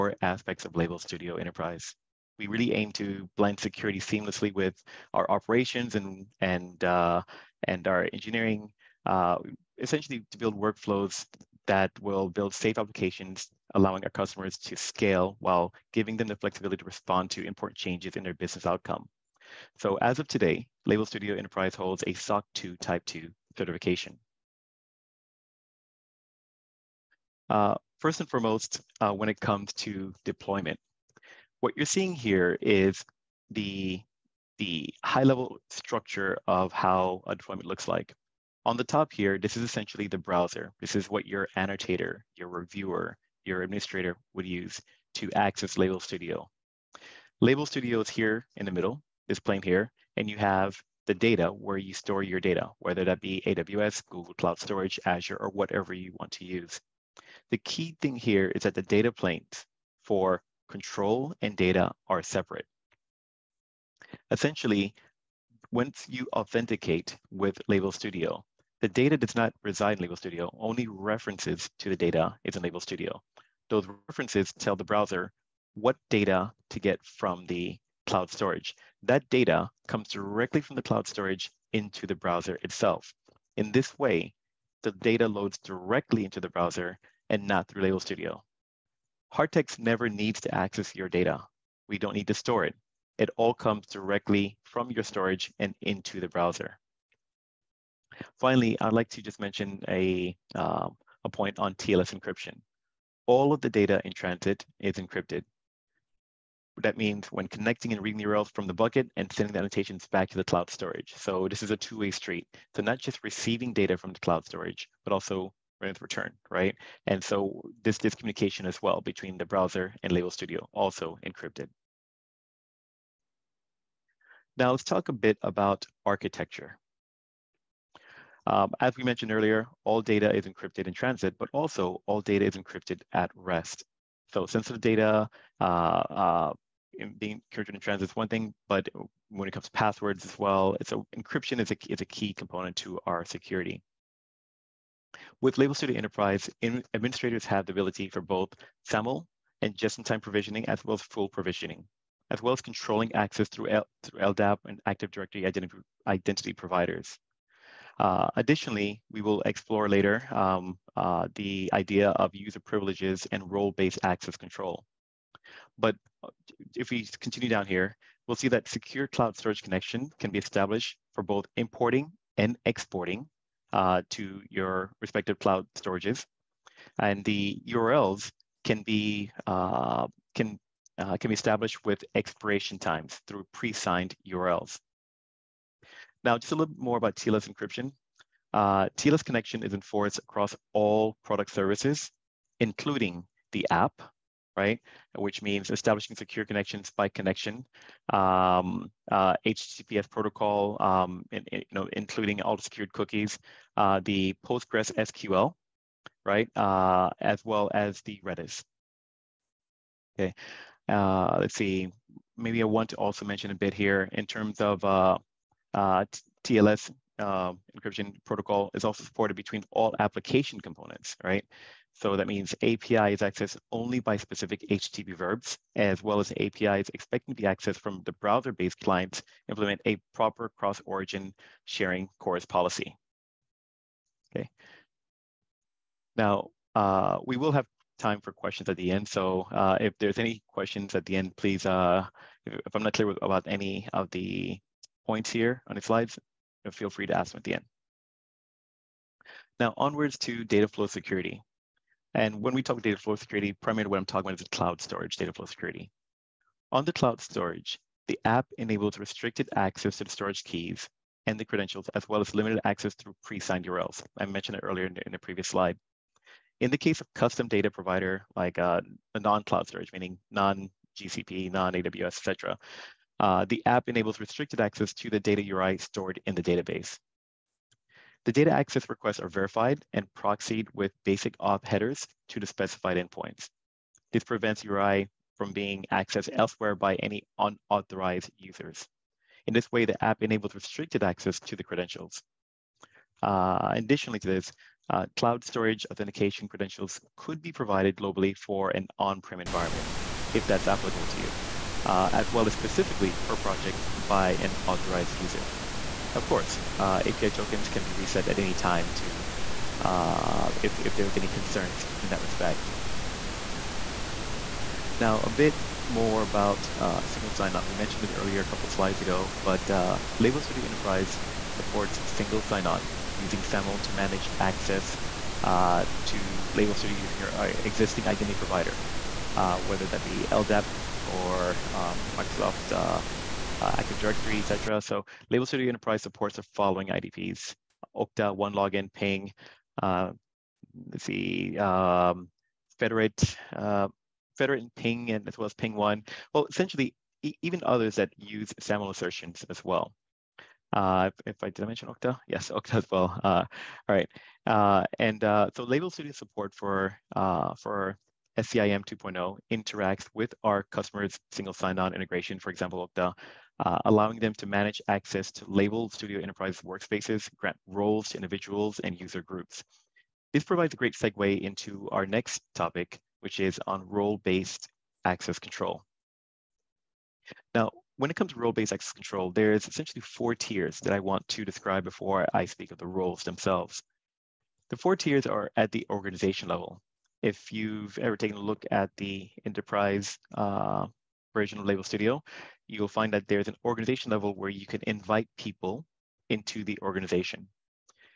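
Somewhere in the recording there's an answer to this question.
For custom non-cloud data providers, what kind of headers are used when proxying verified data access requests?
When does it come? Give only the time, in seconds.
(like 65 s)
281 s.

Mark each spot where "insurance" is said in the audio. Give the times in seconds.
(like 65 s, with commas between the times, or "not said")
not said.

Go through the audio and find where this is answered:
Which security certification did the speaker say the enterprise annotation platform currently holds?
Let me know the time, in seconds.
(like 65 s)
22 s.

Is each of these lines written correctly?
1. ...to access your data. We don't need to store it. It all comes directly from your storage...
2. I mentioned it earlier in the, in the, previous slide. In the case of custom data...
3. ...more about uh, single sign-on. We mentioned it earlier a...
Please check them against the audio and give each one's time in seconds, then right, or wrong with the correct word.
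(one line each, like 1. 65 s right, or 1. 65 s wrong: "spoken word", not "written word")
1. 90 s right
2. 264 s right
3. 315 s right.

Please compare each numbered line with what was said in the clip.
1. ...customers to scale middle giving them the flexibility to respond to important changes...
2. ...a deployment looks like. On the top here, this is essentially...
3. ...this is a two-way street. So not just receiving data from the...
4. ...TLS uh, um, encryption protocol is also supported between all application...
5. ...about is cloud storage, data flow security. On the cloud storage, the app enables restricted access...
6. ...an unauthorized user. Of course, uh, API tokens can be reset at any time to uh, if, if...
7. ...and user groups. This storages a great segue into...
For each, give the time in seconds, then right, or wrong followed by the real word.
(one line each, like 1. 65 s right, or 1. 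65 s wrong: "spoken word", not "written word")
1. 14 s wrong: "while", not "middle"
2. 37 s right
3. 111 s right
4. 216 s right
5. 254 s right
6. 304 s wrong: "authorized", not "unauthorized"
7. 368 s wrong: "provides", not "storages".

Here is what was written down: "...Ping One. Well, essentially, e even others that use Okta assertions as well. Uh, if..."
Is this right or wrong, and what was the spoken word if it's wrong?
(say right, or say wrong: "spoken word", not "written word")
wrong: "SAML", not "Okta".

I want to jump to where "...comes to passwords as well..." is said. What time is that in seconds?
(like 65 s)
139 s.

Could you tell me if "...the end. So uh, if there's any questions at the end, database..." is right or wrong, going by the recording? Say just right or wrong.
wrong.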